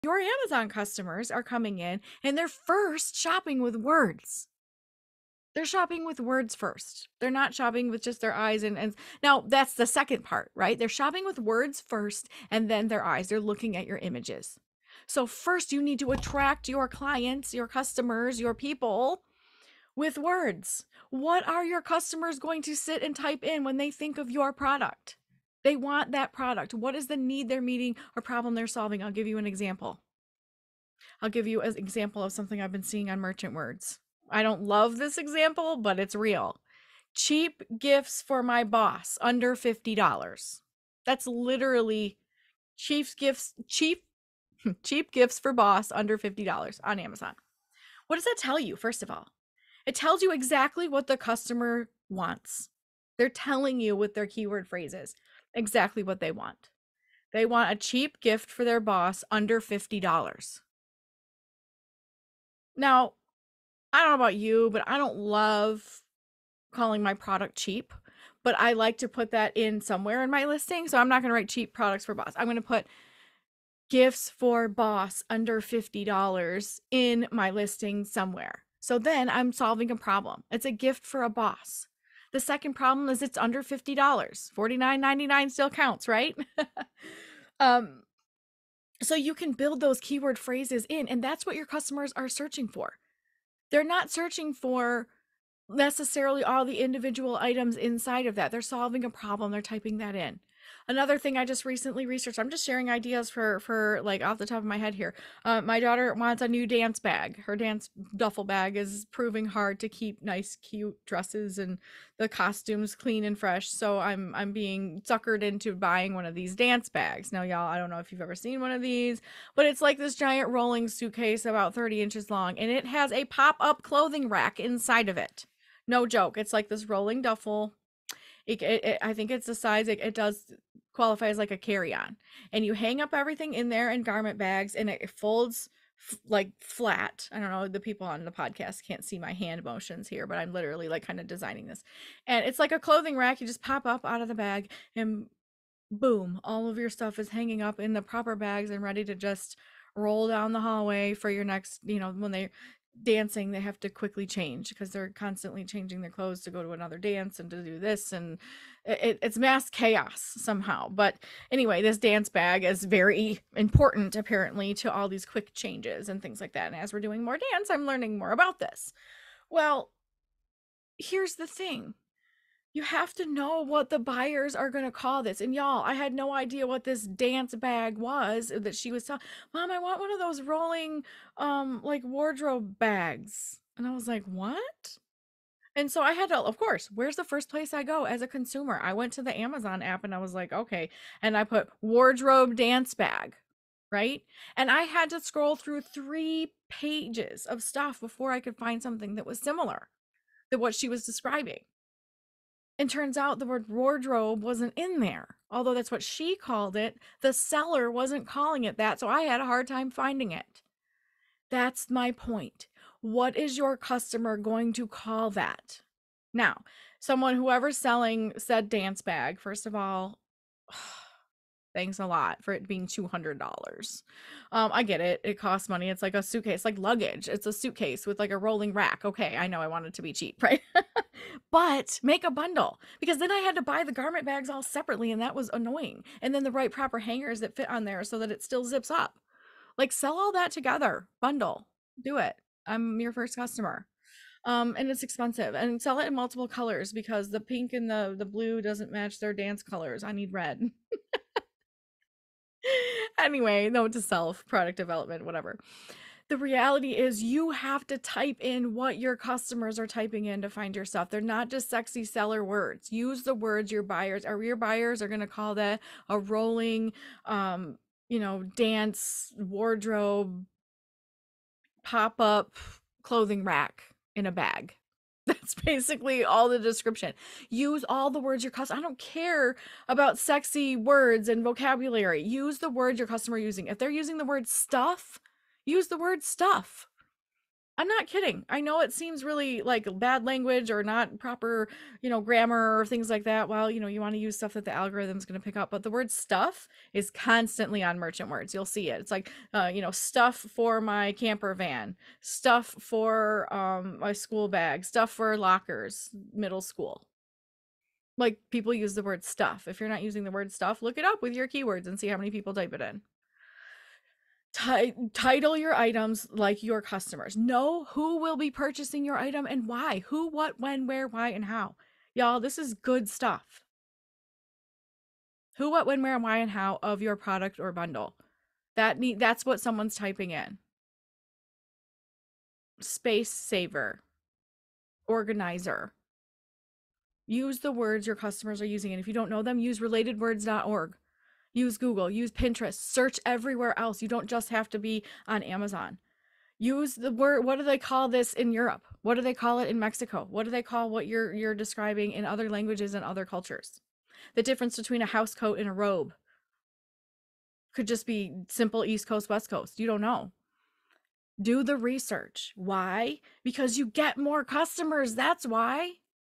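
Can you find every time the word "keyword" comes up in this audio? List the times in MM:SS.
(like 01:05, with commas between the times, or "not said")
00:54, 01:29, 05:11.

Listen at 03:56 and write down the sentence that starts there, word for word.
And then the right proper hangers that fit on there so that it still zips up.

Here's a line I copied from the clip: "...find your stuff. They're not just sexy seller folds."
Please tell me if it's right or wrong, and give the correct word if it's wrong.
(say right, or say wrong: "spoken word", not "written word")
wrong: "words", not "folds".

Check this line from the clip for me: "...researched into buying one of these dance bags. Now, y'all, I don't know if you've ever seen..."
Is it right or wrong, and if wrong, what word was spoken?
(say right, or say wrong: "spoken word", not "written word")
wrong: "suckered", not "researched".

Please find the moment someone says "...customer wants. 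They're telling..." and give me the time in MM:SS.
00:51.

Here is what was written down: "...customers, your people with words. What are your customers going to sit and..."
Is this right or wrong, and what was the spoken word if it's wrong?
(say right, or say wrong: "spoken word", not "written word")
right.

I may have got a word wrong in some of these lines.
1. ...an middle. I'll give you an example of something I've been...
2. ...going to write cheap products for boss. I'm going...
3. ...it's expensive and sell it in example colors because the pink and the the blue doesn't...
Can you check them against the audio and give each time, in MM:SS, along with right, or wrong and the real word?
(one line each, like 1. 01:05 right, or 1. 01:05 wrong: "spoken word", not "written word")
1. 00:29 wrong: "example", not "middle"
2. 01:11 right
3. 04:04 wrong: "multiple", not "example".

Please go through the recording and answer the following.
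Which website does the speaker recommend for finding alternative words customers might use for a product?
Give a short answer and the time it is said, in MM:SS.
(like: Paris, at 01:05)
relatedwords.org, at 05:39.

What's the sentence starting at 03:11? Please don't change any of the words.
And I put wardrobe dance bag, right?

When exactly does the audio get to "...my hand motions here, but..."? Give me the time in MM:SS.
02:19.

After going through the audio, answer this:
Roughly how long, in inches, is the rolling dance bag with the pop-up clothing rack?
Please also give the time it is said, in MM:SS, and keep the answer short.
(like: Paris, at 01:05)
30 inches, at 02:01.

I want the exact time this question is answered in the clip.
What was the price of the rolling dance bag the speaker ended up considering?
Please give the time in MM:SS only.
03:42.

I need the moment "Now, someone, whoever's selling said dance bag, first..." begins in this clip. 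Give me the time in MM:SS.
03:36.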